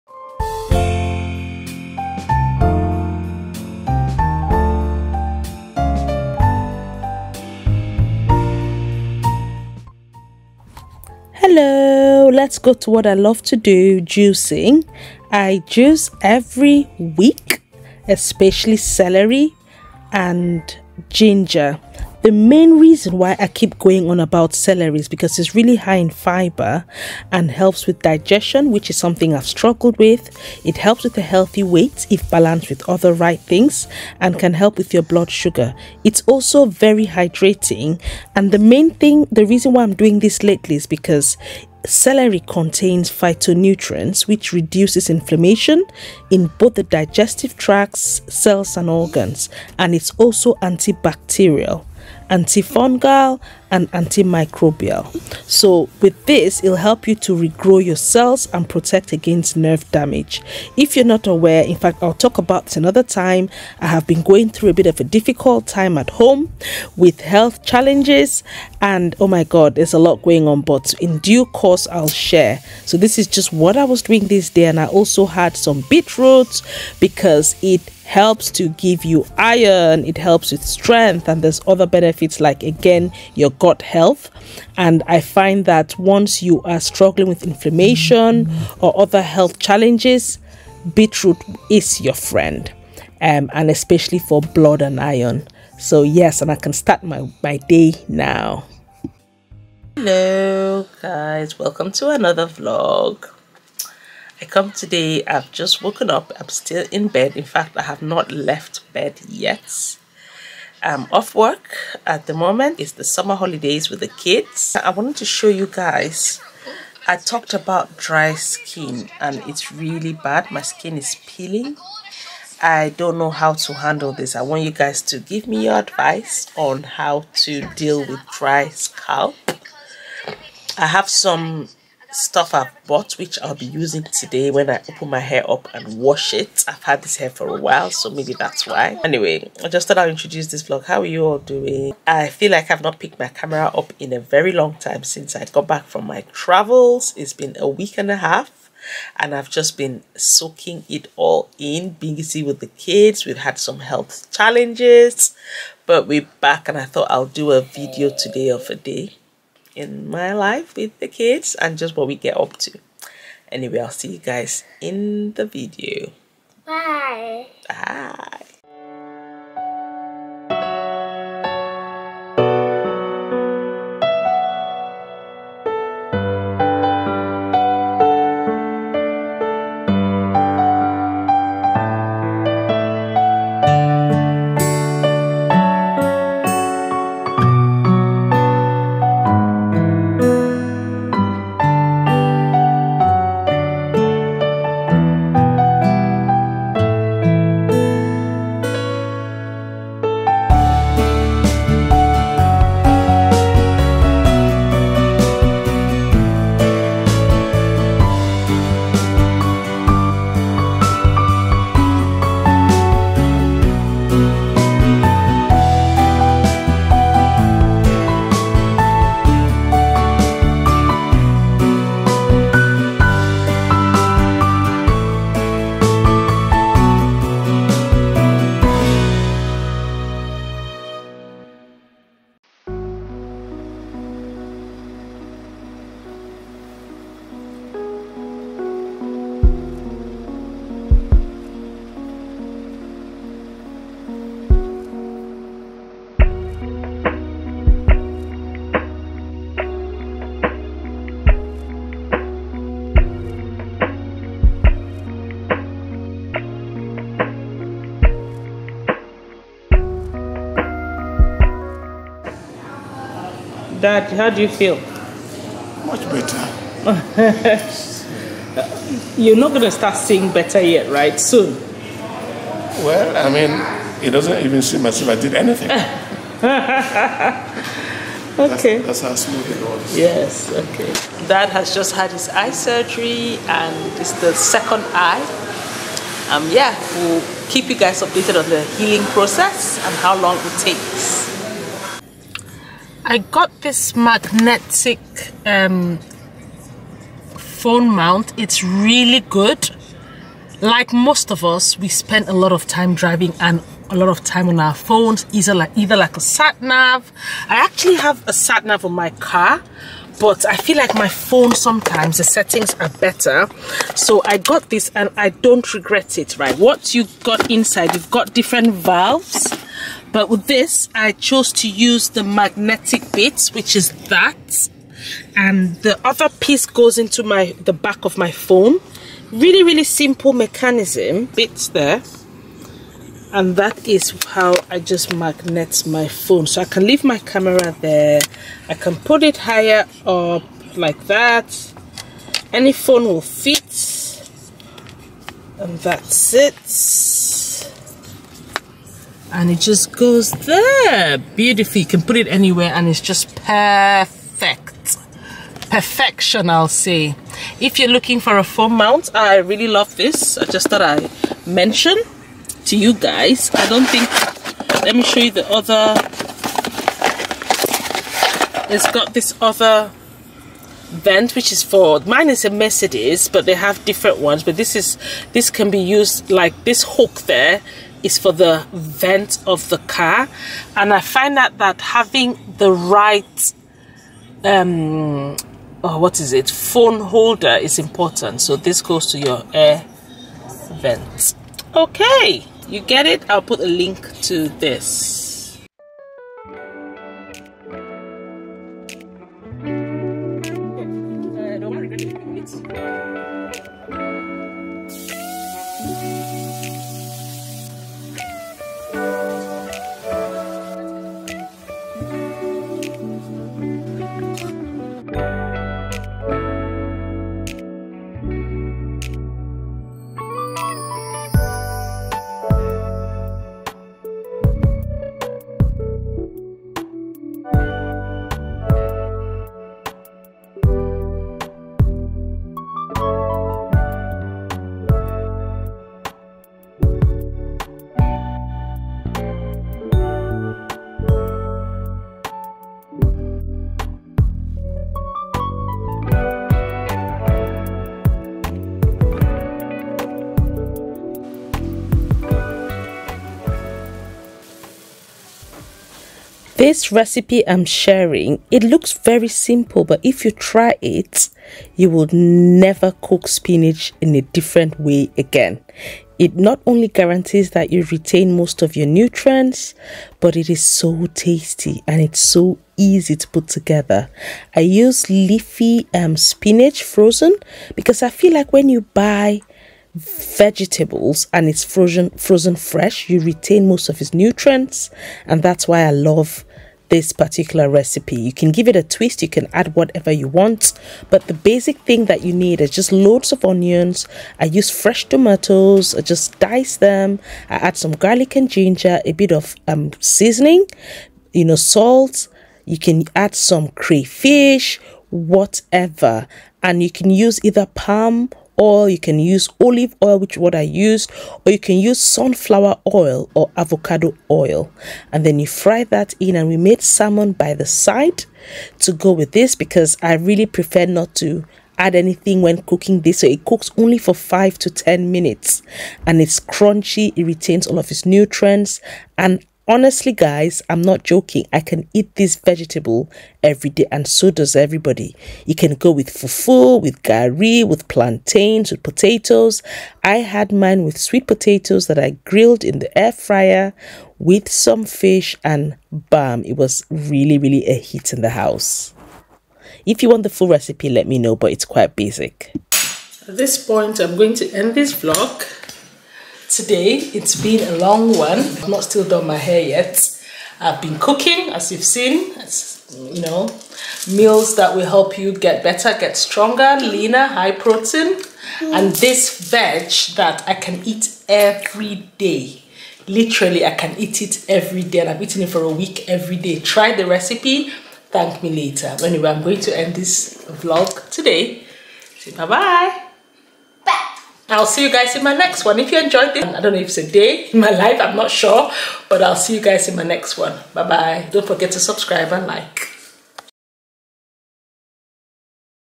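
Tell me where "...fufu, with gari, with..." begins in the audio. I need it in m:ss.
8:56.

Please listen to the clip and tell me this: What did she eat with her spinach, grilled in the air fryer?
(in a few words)
Sweet potatoes.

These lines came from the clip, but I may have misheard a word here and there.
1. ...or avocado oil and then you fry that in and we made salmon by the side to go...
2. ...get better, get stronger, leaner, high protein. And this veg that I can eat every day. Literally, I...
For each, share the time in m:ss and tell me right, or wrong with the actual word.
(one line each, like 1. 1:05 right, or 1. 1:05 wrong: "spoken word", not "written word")
1. 8:33 right
2. 9:25 right.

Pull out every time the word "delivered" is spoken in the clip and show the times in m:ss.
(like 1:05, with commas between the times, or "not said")
not said.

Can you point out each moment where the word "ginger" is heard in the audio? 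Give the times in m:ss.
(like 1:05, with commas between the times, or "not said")
0:21, 8:18.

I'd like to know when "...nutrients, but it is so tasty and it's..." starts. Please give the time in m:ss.
7:48.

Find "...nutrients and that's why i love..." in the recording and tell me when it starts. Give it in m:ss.
8:04.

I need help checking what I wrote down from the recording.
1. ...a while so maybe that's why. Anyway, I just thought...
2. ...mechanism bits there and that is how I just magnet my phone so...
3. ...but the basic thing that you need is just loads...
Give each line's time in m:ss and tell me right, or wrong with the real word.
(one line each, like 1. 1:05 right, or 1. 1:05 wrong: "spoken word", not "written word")
1. 2:17 right
2. 5:30 right
3. 8:11 right.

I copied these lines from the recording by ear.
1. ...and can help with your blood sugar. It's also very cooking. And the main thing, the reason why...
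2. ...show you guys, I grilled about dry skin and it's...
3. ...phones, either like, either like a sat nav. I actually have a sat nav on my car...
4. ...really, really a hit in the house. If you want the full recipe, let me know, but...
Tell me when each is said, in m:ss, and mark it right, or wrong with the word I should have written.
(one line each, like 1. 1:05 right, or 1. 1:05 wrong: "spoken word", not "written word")
1. 0:34 wrong: "hydrating", not "cooking"
2. 1:55 wrong: "talked", not "grilled"
3. 5:04 right
4. 9:06 right.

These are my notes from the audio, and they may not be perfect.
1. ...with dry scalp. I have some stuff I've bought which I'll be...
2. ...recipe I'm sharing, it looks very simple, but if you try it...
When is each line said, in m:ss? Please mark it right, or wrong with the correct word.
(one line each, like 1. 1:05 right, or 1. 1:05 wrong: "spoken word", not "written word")
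1. 2:07 right
2. 7:36 right.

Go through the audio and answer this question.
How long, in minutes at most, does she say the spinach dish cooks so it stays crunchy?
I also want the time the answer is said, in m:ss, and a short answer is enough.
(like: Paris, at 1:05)
10 minutes, at 8:44.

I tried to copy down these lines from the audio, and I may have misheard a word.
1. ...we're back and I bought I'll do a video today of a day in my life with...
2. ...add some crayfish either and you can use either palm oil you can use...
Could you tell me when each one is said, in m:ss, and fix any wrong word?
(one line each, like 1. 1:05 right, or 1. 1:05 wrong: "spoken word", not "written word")
1. 2:36 wrong: "thought", not "bought"
2. 8:23 wrong: "whatever", not "either".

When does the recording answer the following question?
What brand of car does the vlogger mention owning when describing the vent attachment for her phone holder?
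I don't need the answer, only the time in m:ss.
6:12.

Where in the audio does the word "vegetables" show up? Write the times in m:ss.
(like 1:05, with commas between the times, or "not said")
7:59, 8:52.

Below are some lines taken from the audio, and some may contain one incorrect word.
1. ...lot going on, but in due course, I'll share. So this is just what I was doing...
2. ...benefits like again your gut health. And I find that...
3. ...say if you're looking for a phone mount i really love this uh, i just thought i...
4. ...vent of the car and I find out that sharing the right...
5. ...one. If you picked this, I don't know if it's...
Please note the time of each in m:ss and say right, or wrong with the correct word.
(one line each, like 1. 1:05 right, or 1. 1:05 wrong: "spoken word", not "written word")
1. 1:09 right
2. 1:21 right
3. 5:56 right
4. 6:18 wrong: "having", not "sharing"
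5. 9:45 wrong: "enjoyed", not "picked".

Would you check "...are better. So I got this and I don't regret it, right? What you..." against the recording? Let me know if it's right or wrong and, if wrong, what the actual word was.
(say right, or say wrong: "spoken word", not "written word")
right.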